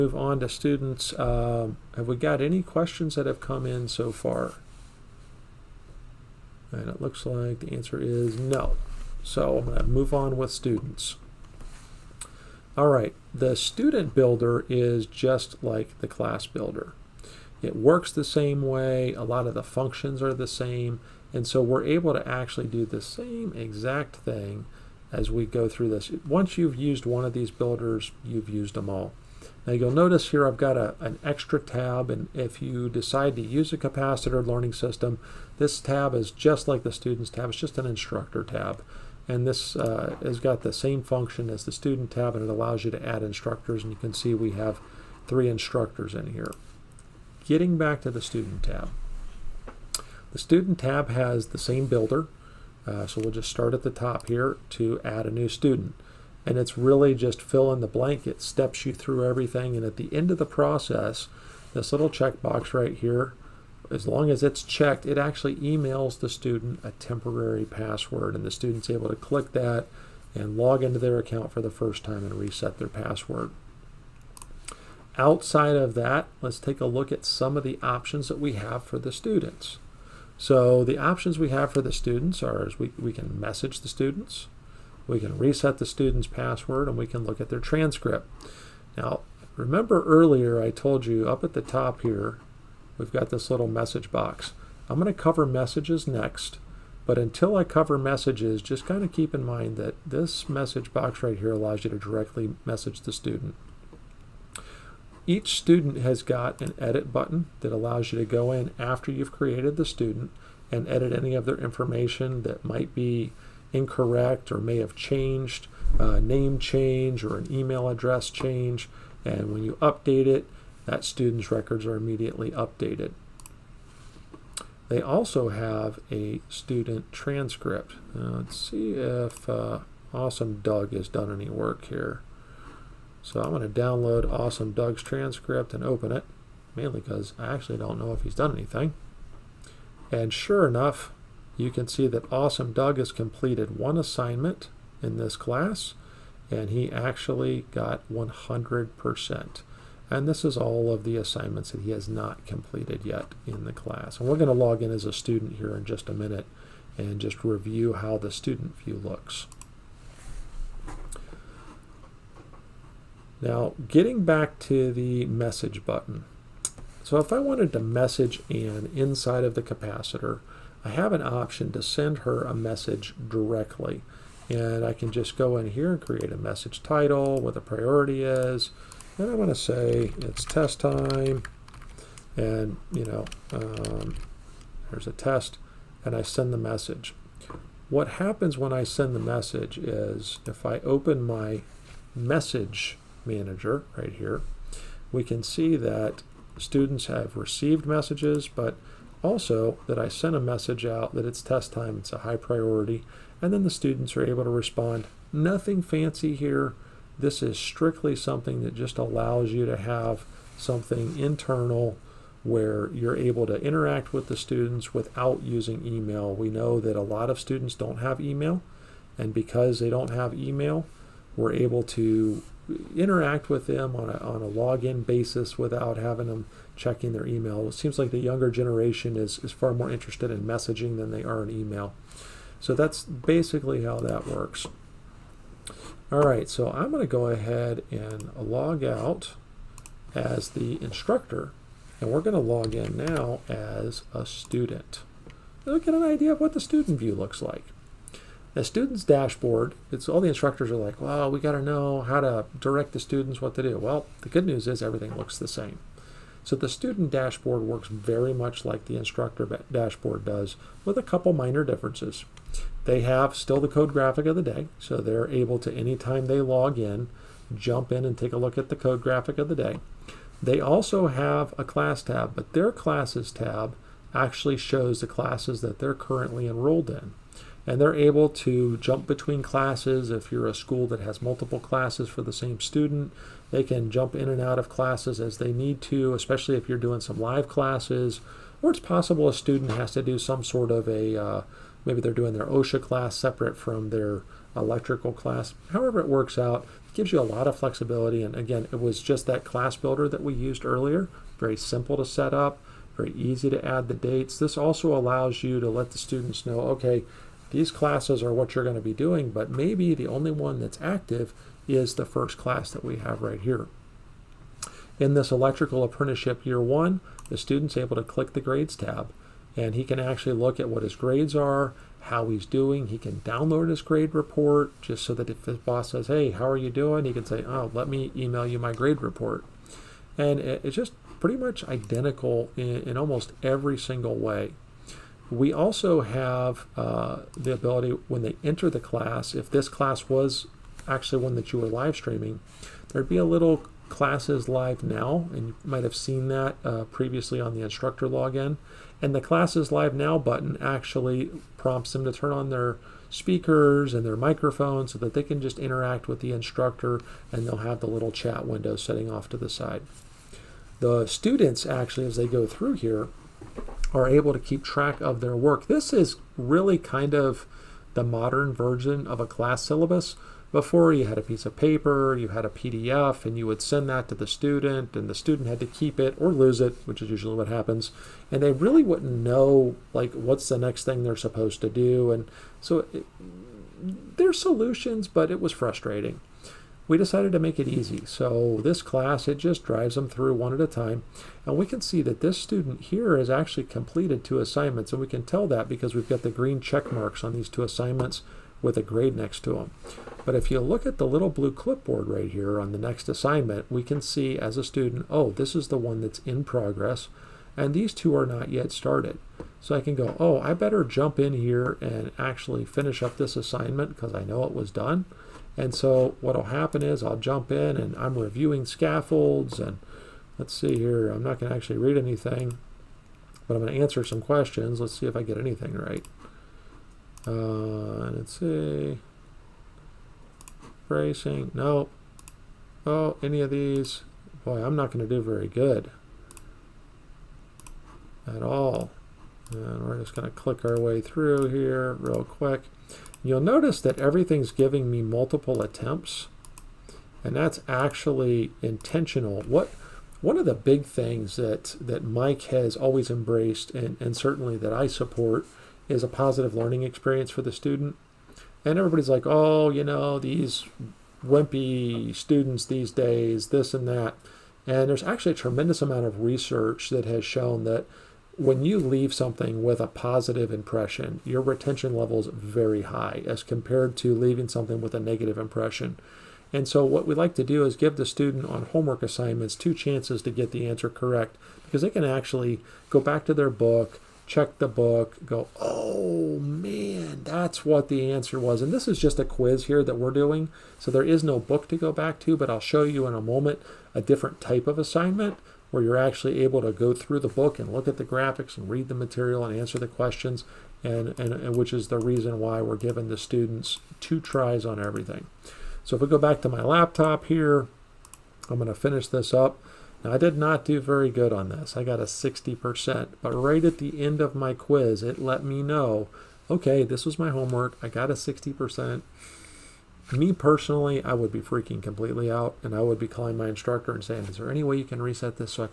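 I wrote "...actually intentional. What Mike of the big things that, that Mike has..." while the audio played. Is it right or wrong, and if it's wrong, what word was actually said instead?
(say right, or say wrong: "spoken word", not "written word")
wrong: "One", not "Mike".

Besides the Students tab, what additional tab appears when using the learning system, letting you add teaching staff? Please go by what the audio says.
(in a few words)
Instructor tab.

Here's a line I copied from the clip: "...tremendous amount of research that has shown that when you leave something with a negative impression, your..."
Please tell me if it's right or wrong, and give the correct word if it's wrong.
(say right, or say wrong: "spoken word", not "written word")
wrong: "positive", not "negative".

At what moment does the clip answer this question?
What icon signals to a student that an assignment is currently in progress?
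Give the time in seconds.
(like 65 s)
401 s.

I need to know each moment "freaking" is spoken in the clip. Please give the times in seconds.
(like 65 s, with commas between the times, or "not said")
521 s.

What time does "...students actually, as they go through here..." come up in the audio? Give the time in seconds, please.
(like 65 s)
361 s.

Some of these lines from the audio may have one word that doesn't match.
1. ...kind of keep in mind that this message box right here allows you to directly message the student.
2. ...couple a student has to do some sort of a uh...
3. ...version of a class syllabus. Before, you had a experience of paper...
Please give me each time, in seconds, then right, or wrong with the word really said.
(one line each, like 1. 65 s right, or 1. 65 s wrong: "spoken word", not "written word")
1. 98 s right
2. 288 s wrong: "possible", not "couple"
3. 368 s wrong: "piece", not "experience".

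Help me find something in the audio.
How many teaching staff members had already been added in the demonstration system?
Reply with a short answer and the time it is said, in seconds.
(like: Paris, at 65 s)
3, at 45 s.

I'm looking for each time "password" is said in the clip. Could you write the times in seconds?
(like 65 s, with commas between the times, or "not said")
67 s, 72 s, 86 s.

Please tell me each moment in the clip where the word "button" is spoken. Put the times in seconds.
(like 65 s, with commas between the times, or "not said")
107 s, 165 s, 350 s.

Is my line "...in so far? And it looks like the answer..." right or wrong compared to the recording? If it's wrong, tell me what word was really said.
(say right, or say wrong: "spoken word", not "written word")
right.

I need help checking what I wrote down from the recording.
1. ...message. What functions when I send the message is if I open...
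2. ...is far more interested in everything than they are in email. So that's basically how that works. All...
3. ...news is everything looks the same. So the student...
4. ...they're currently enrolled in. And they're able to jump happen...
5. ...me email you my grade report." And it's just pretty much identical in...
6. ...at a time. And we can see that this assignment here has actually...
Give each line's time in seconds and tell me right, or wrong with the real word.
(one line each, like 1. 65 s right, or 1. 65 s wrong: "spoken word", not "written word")
1. 186 s wrong: "happens", not "functions"
2. 229 s wrong: "messaging", not "everything"
3. 254 s right
4. 275 s wrong: "between", not "happen"
5. 327 s right
6. 390 s wrong: "student", not "assignment".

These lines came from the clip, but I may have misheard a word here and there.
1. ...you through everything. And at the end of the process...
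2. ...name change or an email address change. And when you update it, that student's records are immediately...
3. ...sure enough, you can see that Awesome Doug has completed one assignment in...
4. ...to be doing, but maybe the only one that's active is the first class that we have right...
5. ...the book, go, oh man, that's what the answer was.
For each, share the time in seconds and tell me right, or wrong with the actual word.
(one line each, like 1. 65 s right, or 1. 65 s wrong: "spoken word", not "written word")
1. 58 s right
2. 116 s right
3. 140 s right
4. 308 s right
5. 484 s right.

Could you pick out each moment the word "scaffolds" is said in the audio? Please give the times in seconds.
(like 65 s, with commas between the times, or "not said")
418 s.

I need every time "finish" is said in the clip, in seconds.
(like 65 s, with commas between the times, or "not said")
412 s, 508 s.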